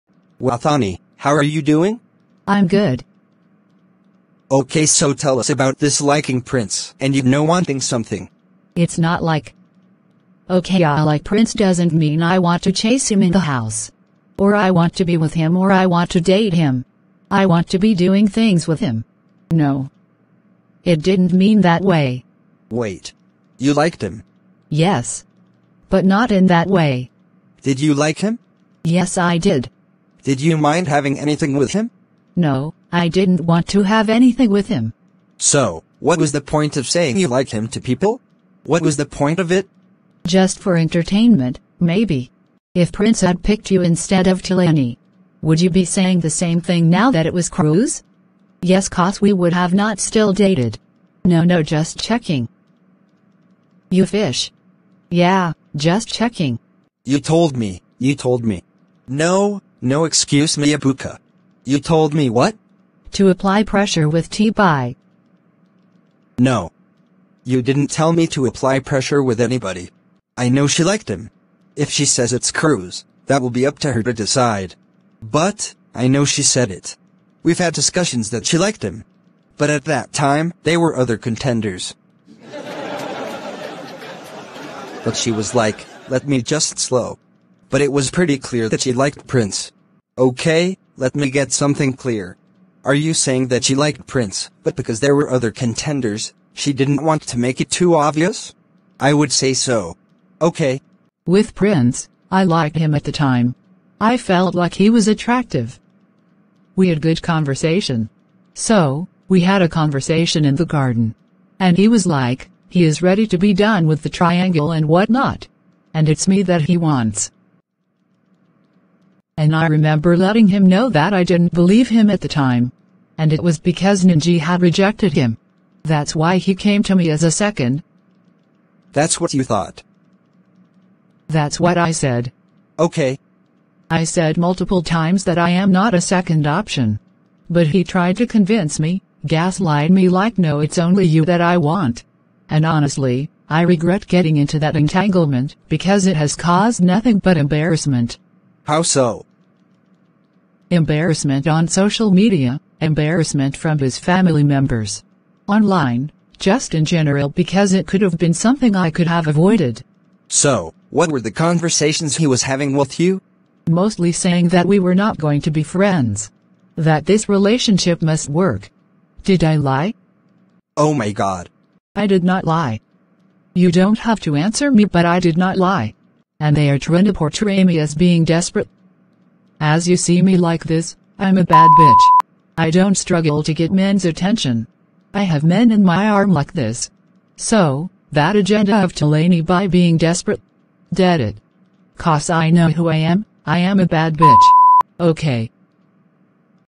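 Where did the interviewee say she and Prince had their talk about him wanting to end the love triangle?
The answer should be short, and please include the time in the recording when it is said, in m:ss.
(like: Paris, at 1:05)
The garden, at 1:50.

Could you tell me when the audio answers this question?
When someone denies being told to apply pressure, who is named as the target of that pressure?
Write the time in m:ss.
1:04.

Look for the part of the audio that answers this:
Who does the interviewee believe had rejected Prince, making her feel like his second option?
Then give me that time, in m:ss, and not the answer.
2:04.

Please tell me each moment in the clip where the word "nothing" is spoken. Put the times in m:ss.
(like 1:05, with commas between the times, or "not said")
2:26.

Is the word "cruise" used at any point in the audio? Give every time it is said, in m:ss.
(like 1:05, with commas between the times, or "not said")
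0:47, 1:12.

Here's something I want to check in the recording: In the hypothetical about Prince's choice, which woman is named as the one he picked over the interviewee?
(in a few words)
Tolani.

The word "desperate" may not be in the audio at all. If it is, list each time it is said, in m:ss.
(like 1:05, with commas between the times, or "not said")
2:58, 3:09.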